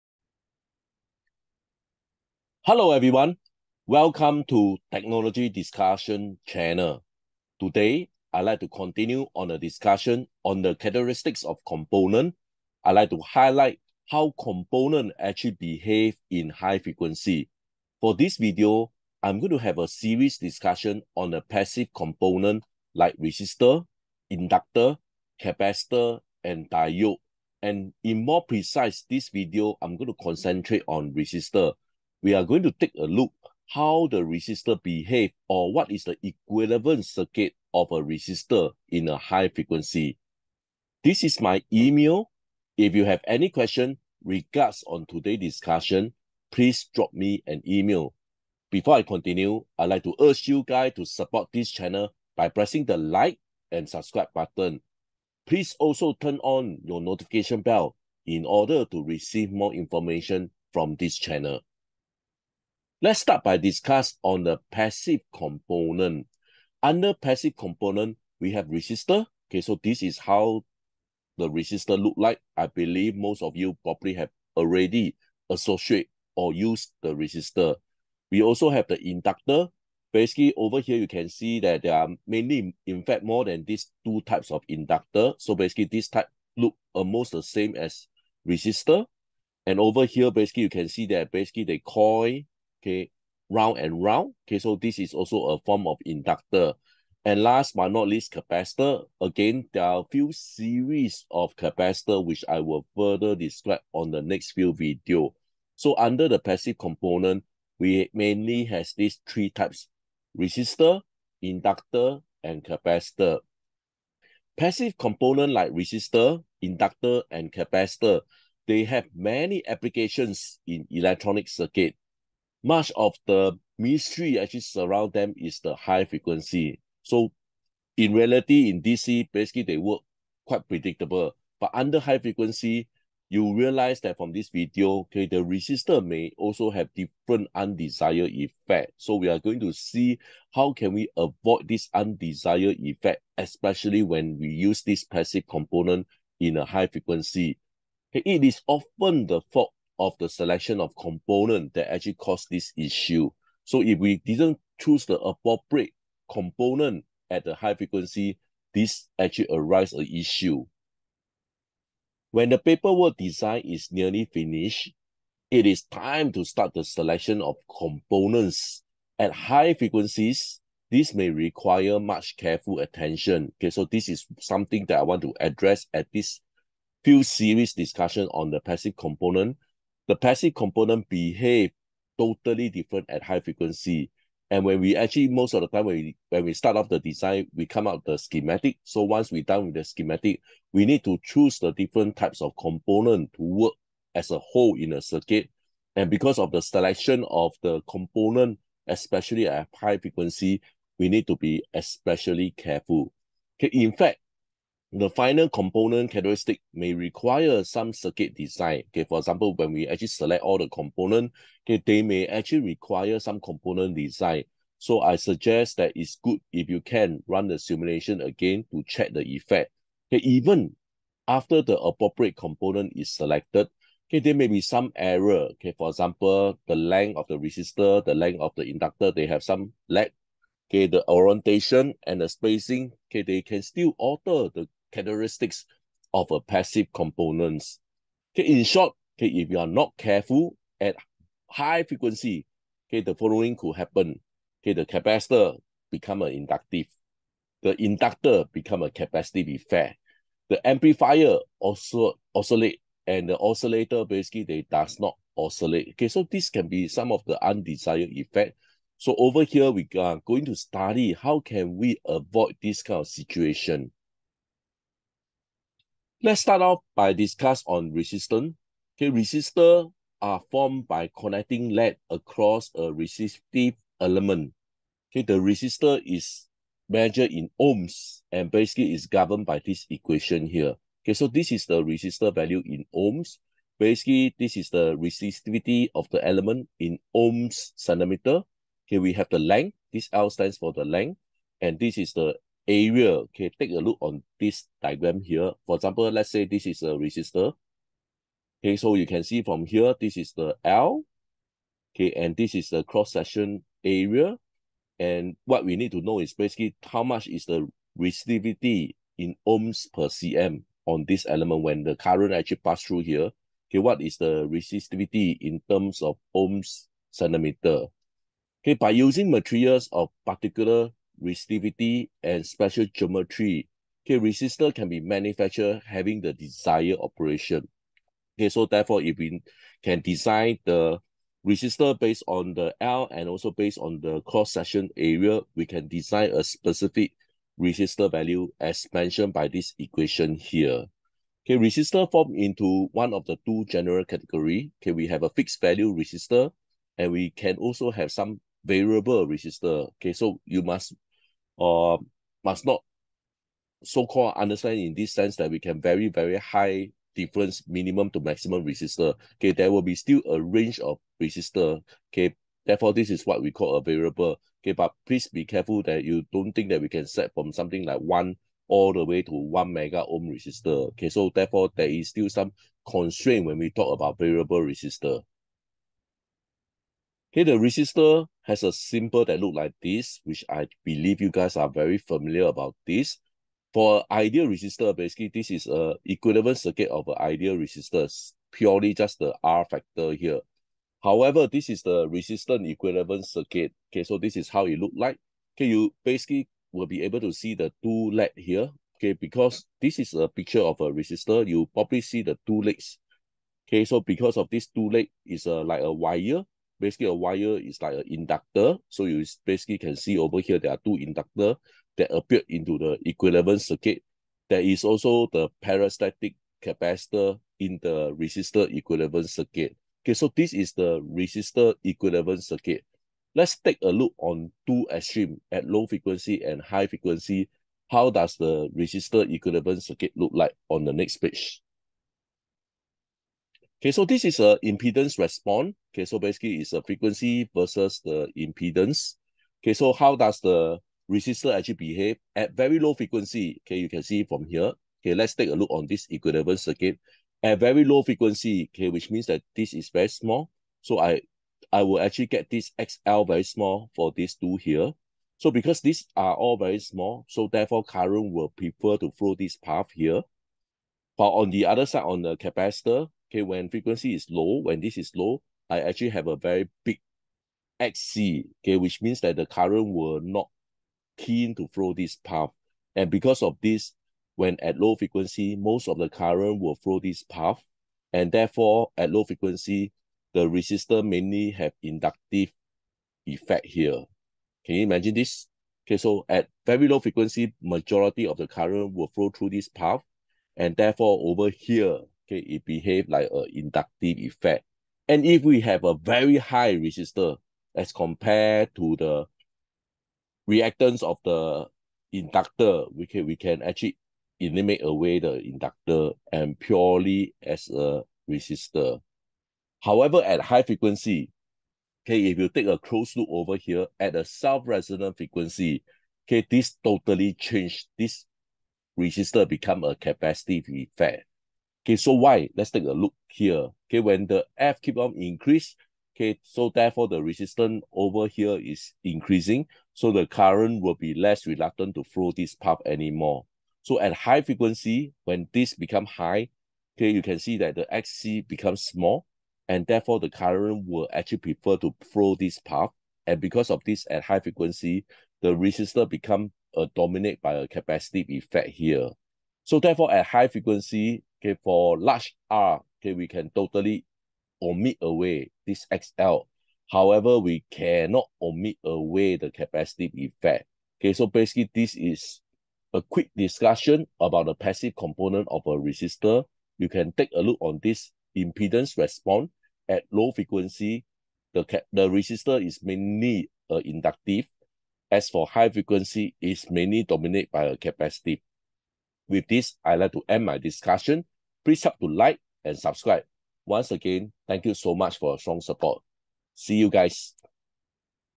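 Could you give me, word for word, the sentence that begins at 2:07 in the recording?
So in reality, in DC, basically they work quite predictable.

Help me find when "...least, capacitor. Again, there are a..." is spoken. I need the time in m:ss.
1:38.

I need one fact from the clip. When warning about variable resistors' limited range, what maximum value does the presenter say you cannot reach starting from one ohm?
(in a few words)
1 megaohm.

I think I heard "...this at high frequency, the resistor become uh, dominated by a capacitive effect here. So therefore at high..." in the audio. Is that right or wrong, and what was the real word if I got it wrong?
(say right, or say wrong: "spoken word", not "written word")
right.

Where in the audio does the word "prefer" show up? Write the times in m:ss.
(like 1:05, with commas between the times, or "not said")
7:38, 9:01.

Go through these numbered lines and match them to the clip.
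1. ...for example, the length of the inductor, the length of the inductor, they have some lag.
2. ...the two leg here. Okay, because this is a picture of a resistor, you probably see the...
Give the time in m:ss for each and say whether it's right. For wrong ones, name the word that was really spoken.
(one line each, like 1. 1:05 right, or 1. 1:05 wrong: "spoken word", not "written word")
1. 3:45 wrong: "resistor", not "inductor"
2. 6:37 right.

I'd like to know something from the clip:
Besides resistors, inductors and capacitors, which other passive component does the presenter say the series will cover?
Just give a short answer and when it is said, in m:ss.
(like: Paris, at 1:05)
Diode, at 0:26.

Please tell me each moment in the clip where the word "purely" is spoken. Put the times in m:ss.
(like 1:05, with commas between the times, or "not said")
6:28, 8:26.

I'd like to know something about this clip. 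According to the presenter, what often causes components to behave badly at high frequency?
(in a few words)
Selection of component.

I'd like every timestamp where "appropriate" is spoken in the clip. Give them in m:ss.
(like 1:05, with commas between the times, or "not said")
2:35, 3:41.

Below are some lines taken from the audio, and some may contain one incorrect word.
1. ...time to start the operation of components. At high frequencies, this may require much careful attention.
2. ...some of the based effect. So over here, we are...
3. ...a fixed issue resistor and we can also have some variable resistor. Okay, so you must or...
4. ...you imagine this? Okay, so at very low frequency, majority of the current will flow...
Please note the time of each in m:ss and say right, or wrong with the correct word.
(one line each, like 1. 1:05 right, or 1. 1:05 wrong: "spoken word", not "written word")
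1. 2:45 wrong: "selection", not "operation"
2. 4:16 wrong: "undesired", not "based"
3. 5:45 wrong: "value", not "issue"
4. 8:04 right.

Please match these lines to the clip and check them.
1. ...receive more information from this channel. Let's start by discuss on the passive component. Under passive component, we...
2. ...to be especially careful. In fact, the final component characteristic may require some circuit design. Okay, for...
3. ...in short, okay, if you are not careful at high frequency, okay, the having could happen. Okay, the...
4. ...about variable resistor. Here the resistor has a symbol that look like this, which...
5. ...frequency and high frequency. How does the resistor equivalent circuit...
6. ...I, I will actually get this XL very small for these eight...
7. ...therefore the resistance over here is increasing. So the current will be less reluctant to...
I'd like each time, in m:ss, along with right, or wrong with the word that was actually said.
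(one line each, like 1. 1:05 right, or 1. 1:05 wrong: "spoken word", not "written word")
1. 0:59 right
2. 3:21 right
3. 3:58 wrong: "following", not "having"
4. 6:13 right
5. 7:05 right
6. 7:30 wrong: "two", not "eight"
7. 8:46 right.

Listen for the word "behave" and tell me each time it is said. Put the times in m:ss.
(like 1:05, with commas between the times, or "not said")
0:15, 0:34, 3:01, 7:21, 8:12.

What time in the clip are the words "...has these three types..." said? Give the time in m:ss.
1:48.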